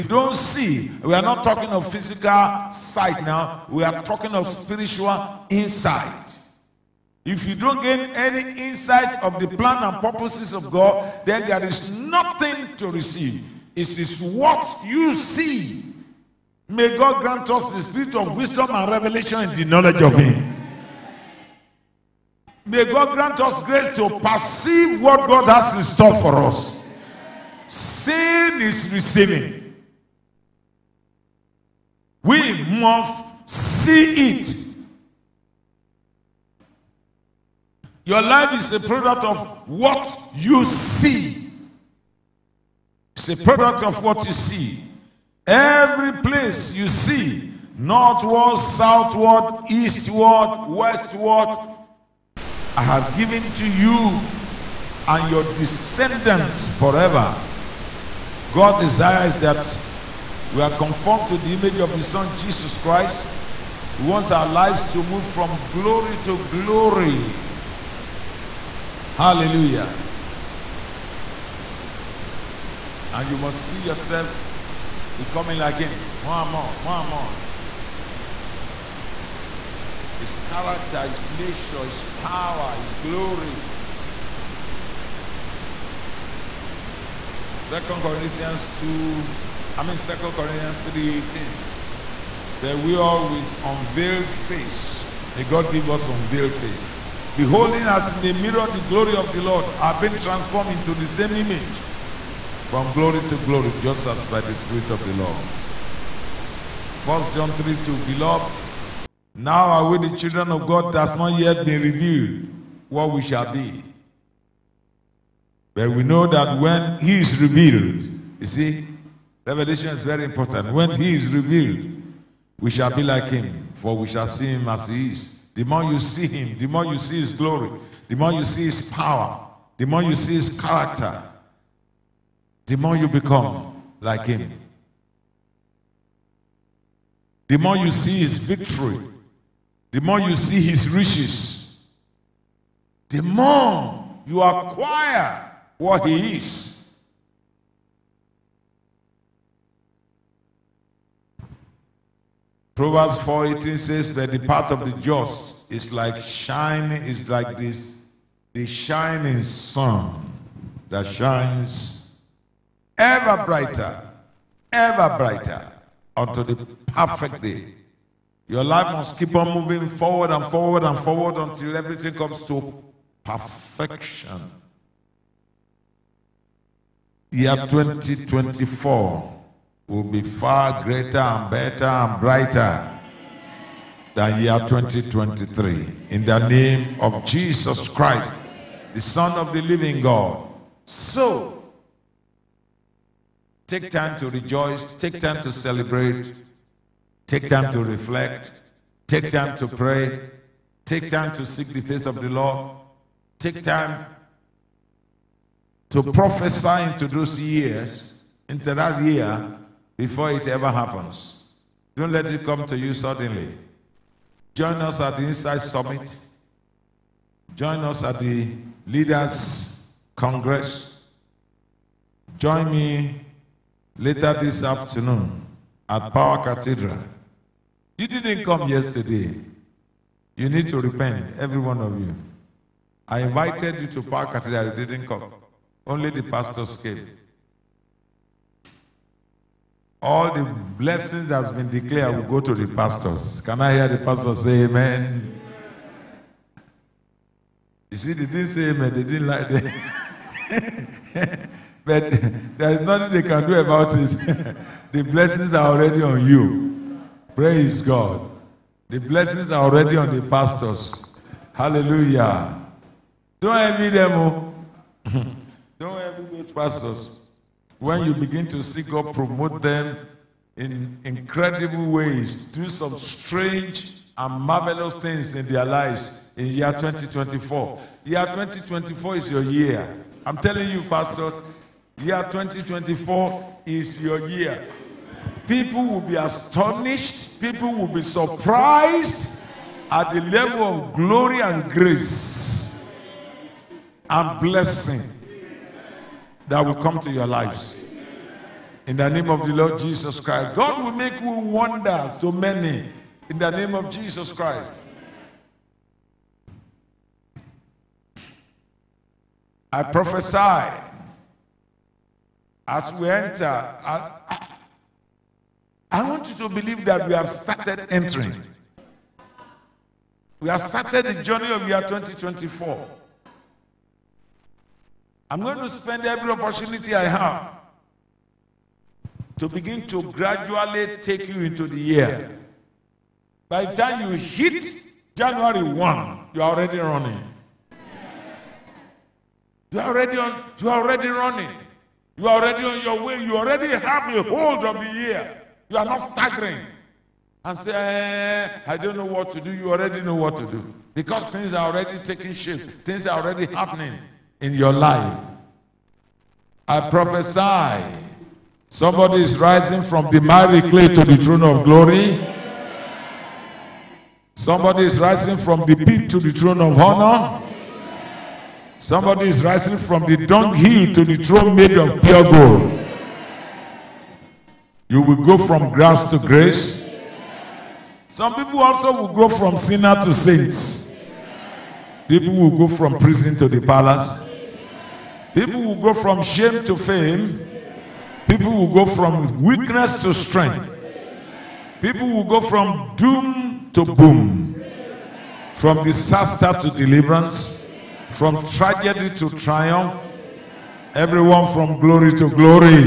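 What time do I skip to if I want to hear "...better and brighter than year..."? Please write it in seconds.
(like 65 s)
181 s.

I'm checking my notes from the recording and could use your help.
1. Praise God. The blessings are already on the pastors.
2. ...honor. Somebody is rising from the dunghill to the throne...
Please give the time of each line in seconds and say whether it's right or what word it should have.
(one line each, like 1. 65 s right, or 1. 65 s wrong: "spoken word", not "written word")
1. 257 s right
2. 366 s right.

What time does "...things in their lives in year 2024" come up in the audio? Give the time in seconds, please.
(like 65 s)
274 s.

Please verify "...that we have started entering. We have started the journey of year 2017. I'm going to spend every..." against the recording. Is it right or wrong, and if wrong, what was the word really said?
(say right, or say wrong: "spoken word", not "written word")
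wrong: "2024", not "2017".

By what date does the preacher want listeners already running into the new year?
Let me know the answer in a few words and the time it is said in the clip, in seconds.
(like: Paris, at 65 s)
January 1, at 335 s.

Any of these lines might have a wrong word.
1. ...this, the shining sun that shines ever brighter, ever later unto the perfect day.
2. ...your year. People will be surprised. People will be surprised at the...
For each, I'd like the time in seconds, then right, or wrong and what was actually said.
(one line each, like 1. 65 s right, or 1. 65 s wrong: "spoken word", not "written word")
1. 157 s wrong: "brighter", not "later"
2. 284 s wrong: "astonished", not "surprised".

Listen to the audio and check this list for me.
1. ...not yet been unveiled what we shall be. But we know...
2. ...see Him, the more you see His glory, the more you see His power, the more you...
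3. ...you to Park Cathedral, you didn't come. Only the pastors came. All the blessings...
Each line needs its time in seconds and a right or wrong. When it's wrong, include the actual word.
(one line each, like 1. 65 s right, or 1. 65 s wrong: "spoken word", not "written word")
1. 111 s wrong: "revealed", not "unveiled"
2. 125 s right
3. 233 s right.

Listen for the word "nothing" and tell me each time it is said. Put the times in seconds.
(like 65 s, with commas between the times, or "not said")
11 s, 252 s.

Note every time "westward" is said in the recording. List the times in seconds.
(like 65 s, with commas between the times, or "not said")
50 s.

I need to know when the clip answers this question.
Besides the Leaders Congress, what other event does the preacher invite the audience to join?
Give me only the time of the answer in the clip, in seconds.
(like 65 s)
215 s.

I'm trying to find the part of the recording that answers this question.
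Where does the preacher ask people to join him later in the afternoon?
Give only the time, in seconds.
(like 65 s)
226 s.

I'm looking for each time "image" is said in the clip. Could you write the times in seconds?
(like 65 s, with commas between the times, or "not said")
61 s, 101 s.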